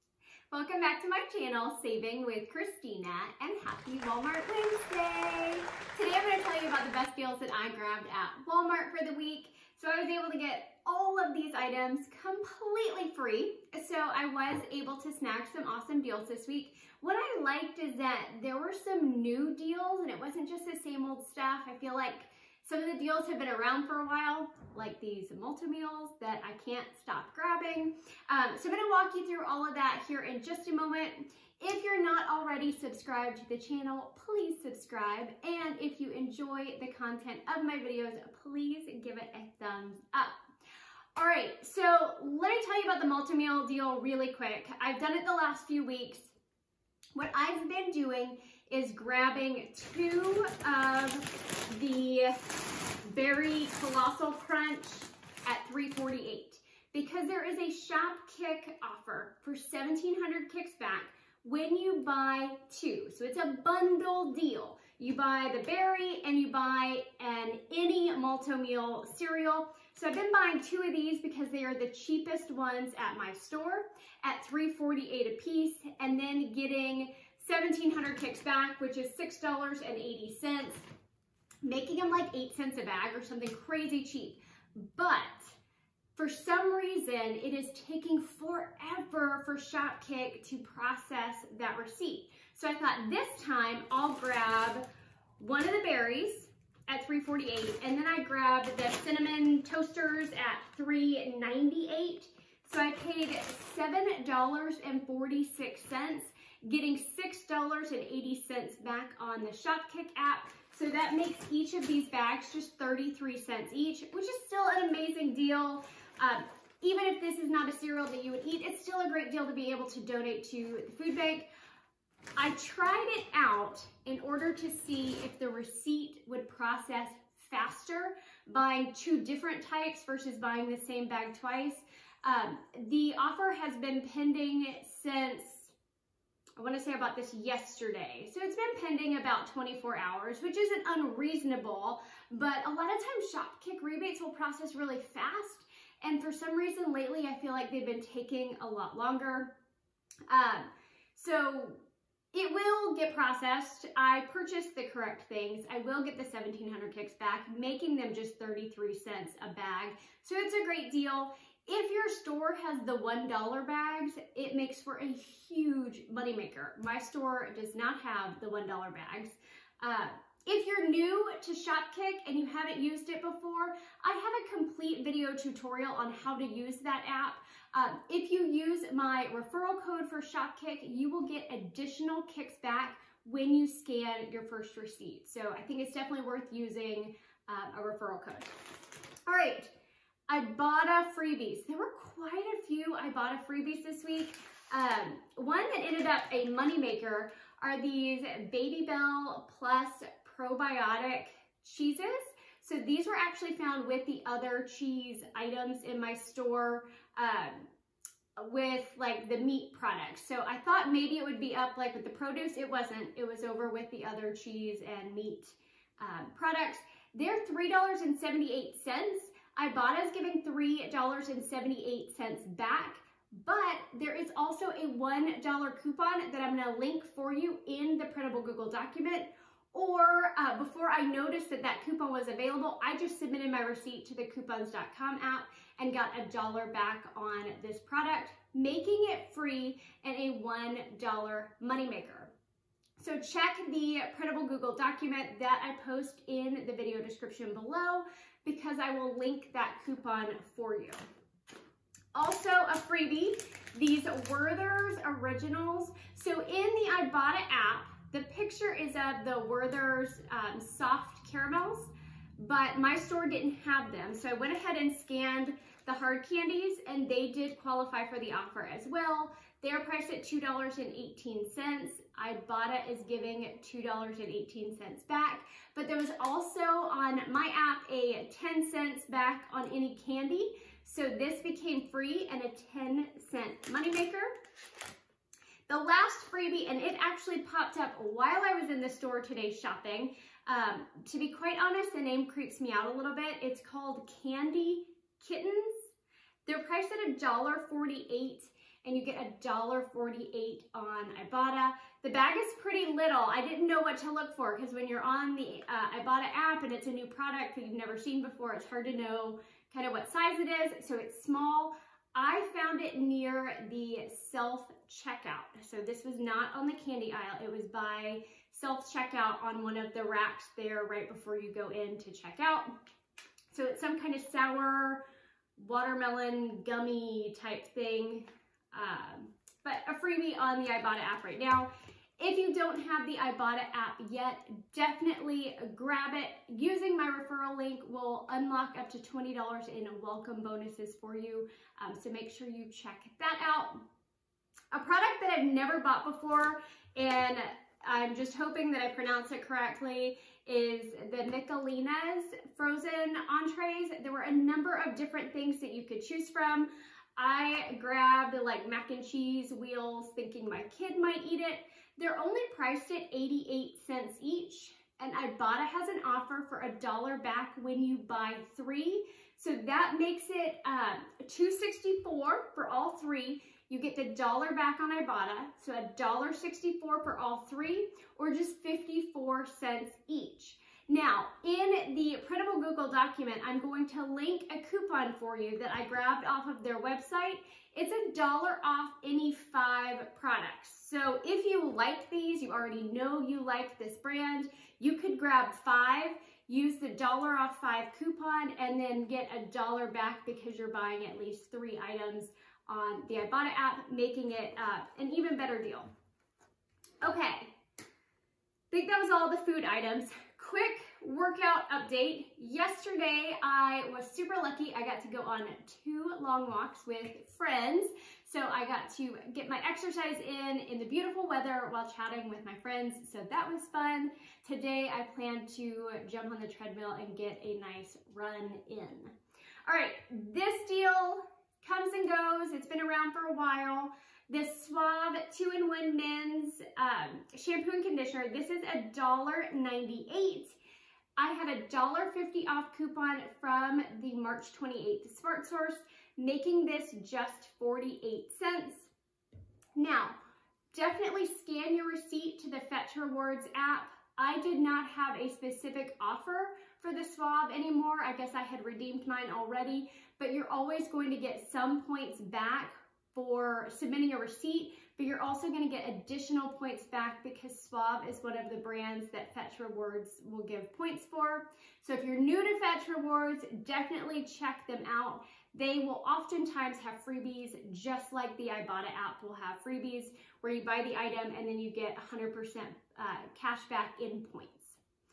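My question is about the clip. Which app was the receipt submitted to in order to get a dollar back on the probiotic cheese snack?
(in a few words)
coupons.com.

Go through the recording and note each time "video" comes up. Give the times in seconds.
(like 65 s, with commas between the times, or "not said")
37 s, 175 s, 246 s.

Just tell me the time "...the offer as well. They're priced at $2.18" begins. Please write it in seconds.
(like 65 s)
268 s.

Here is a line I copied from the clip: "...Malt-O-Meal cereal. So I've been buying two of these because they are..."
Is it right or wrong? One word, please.
right.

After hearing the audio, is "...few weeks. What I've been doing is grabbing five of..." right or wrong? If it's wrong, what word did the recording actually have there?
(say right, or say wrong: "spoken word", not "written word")
wrong: "two", not "five".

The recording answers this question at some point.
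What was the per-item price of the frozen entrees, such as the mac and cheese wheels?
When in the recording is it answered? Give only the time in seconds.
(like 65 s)
363 s.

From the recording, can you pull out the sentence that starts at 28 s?
Um, so I'm gonna walk you through all of that here in just a moment.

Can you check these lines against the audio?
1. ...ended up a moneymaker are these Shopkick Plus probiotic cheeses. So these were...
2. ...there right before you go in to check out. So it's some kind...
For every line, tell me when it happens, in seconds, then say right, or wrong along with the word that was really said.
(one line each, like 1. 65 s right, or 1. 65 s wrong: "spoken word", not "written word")
1. 195 s wrong: "Babybel", not "Shopkick"
2. 320 s right.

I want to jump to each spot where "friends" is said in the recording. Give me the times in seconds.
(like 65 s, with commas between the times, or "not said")
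417 s, 422 s.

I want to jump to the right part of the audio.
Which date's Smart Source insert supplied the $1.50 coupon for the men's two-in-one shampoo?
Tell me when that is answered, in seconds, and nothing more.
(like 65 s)
444 s.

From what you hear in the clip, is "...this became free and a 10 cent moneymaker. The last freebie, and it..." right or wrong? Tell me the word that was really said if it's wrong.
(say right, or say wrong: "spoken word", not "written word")
right.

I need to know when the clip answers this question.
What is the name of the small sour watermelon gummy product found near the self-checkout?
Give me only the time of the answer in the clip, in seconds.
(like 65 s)
294 s.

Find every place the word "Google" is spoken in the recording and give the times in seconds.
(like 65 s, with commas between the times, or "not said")
228 s, 244 s, 382 s.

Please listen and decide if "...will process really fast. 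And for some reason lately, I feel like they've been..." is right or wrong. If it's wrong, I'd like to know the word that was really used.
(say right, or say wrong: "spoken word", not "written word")
right.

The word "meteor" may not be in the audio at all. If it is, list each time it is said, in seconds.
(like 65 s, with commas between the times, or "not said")
not said.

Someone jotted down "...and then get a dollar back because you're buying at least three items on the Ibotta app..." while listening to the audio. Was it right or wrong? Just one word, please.
right.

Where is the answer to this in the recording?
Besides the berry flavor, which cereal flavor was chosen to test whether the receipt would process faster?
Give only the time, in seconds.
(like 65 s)
99 s.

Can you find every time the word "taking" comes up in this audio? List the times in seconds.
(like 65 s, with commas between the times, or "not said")
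87 s, 148 s.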